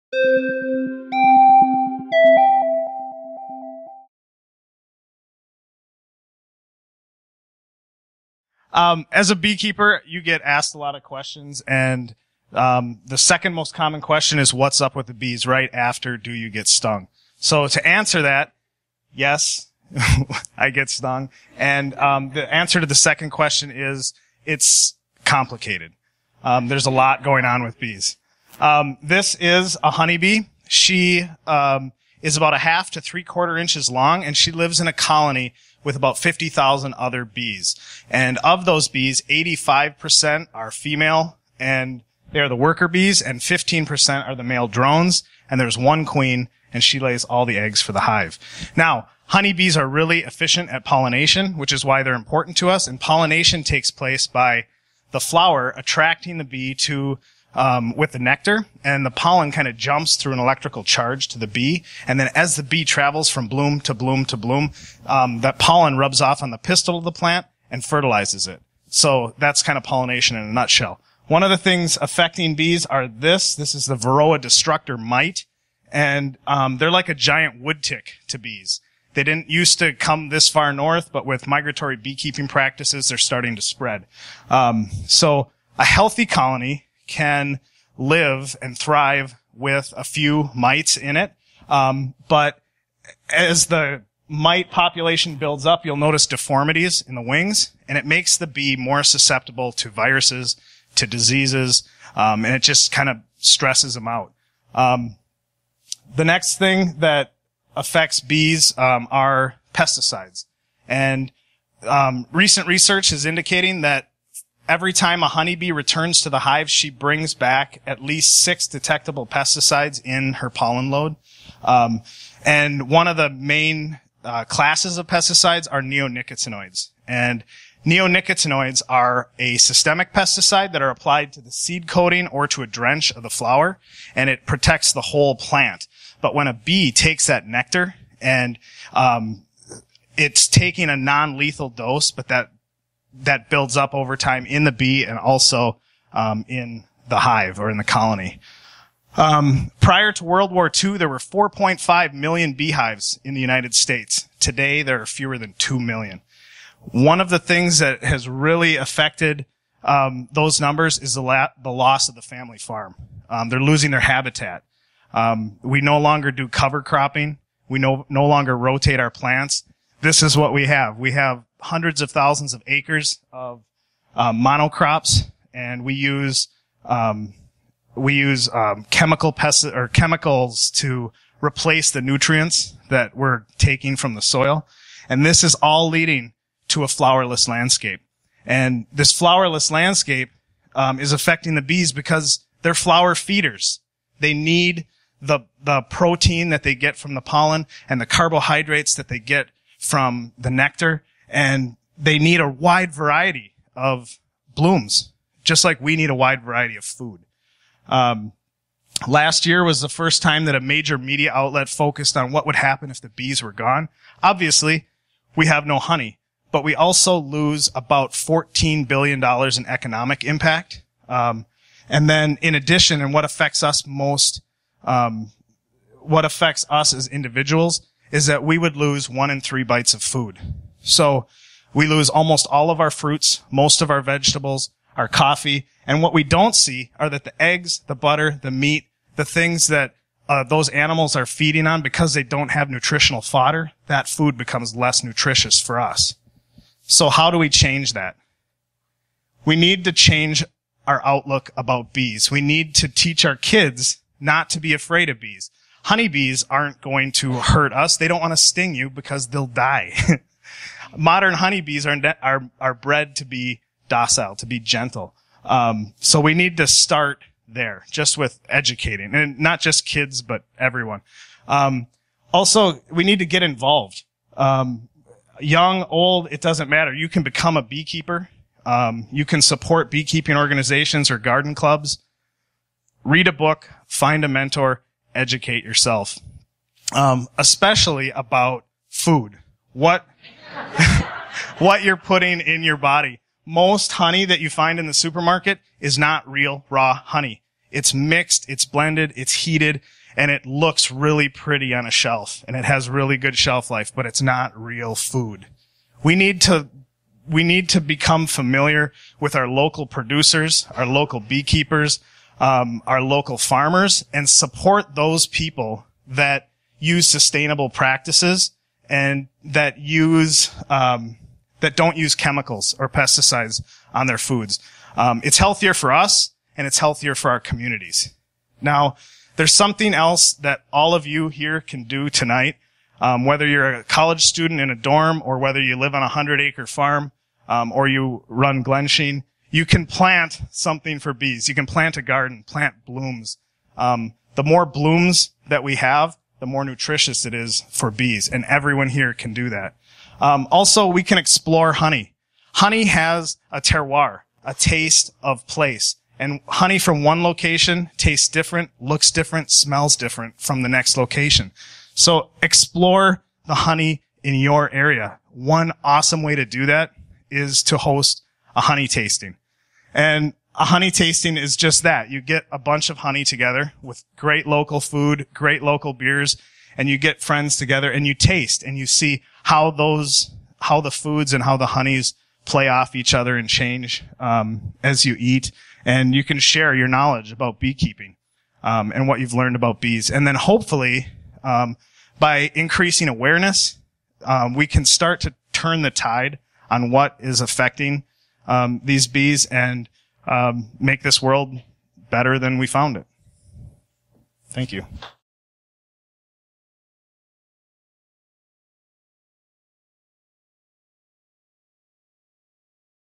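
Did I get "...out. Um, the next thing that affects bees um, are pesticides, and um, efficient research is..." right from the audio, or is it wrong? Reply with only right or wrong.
wrong.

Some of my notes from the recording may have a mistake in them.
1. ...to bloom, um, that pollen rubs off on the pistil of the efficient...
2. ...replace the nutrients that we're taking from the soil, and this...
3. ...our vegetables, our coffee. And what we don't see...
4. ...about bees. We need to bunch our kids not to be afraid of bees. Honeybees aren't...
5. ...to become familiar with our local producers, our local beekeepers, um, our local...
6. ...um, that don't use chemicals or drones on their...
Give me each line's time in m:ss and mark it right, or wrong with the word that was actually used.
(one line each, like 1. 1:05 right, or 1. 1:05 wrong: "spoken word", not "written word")
1. 1:04 wrong: "plant", not "efficient"
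2. 3:01 right
3. 3:53 right
4. 4:11 wrong: "teach", not "bunch"
5. 5:07 right
6. 5:20 wrong: "pesticides", not "drones".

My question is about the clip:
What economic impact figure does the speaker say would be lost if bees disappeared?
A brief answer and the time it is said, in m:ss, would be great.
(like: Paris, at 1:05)
$14 billion, at 3:38.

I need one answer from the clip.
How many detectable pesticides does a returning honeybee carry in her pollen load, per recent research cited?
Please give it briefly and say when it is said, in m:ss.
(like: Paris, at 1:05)
6, at 1:58.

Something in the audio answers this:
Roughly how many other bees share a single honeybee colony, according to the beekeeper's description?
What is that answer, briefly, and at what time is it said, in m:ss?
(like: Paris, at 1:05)
50,000, at 0:36.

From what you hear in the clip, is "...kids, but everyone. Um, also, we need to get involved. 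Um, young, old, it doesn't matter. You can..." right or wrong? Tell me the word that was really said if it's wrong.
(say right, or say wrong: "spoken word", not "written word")
right.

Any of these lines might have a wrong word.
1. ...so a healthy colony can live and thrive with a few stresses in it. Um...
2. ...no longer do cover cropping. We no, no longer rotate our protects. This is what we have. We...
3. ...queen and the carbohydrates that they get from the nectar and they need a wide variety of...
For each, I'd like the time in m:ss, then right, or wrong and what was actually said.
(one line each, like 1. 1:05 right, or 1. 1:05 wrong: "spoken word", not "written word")
1. 1:25 wrong: "mites", not "stresses"
2. 2:45 wrong: "plants", not "protects"
3. 3:17 wrong: "pollen", not "queen".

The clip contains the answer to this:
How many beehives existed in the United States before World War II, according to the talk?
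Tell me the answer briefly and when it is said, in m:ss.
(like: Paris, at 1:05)
4.5 million, at 2:31.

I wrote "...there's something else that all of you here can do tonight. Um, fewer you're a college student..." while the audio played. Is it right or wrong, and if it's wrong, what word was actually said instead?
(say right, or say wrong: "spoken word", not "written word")
wrong: "whether", not "fewer".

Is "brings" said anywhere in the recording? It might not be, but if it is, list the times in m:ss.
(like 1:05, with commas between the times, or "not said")
1:56.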